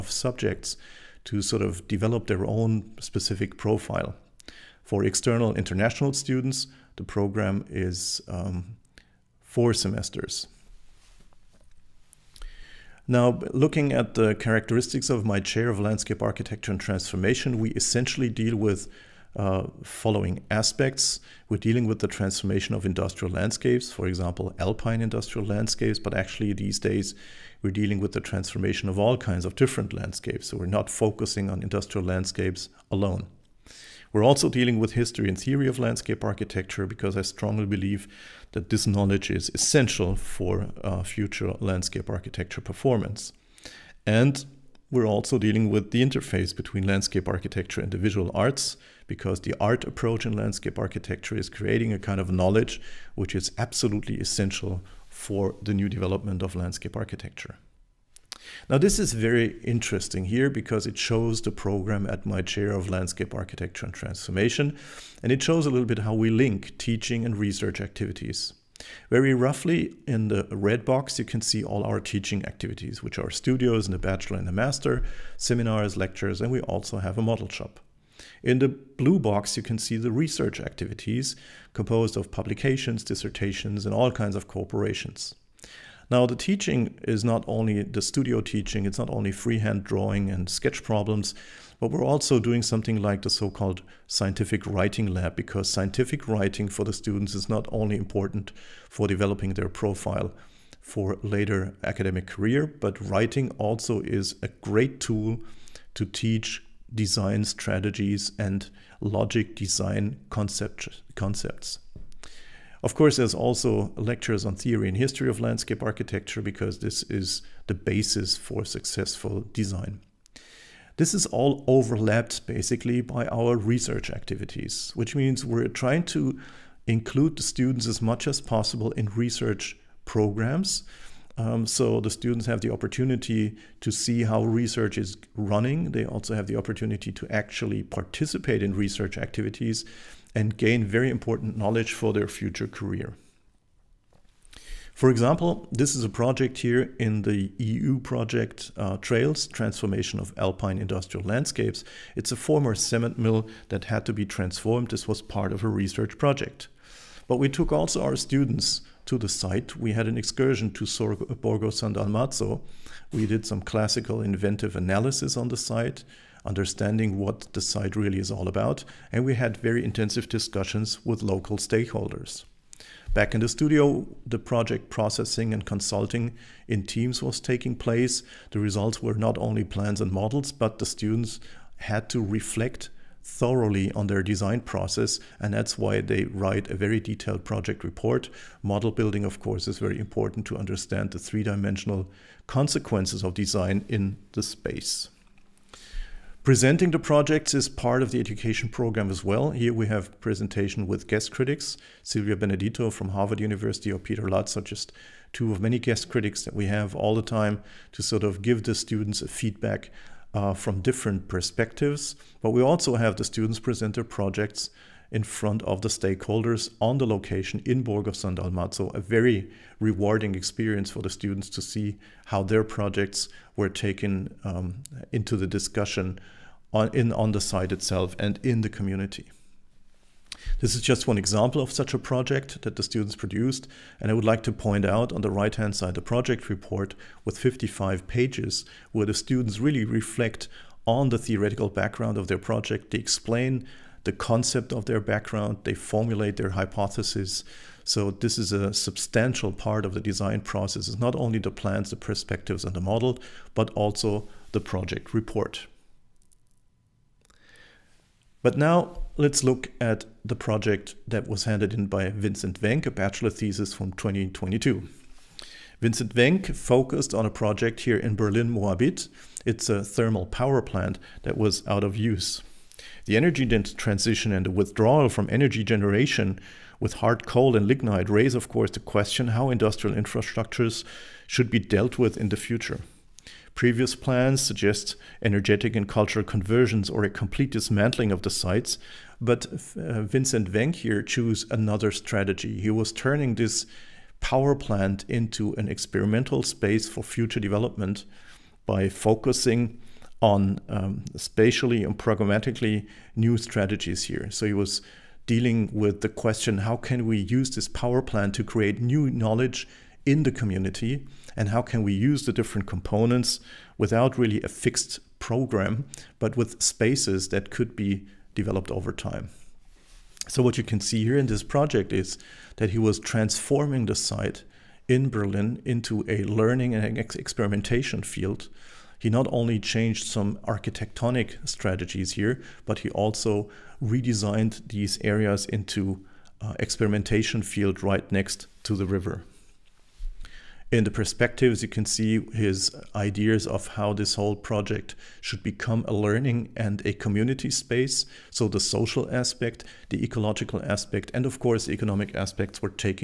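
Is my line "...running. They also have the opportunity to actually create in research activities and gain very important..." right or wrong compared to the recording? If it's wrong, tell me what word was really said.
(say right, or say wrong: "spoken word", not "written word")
wrong: "participate", not "create".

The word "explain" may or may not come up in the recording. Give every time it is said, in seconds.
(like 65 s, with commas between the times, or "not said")
242 s.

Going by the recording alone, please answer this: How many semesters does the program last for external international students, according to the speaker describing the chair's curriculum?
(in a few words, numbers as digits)
4.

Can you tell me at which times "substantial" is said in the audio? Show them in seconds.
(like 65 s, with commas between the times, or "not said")
248 s.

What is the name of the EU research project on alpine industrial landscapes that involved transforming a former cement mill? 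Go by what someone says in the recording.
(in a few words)
Trails.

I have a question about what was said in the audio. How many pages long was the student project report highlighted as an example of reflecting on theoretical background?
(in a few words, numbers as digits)
55.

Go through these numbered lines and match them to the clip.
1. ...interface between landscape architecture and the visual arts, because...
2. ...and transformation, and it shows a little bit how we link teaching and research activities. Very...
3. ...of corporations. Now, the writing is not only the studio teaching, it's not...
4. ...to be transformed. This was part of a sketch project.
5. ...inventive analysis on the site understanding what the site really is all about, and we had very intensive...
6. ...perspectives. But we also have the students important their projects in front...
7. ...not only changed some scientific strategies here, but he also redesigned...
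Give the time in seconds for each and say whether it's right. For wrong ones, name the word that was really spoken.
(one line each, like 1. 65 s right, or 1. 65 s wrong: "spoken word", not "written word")
1. 46 s right
2. 63 s right
3. 84 s wrong: "teaching", not "writing"
4. 154 s wrong: "research", not "sketch"
5. 164 s right
6. 211 s wrong: "present", not "important"
7. 329 s wrong: "architectonic", not "scientific".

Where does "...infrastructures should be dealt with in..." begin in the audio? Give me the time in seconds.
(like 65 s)
279 s.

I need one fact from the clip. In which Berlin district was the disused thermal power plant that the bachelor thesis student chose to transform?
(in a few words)
Moabit.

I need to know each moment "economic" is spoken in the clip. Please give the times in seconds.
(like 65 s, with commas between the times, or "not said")
351 s.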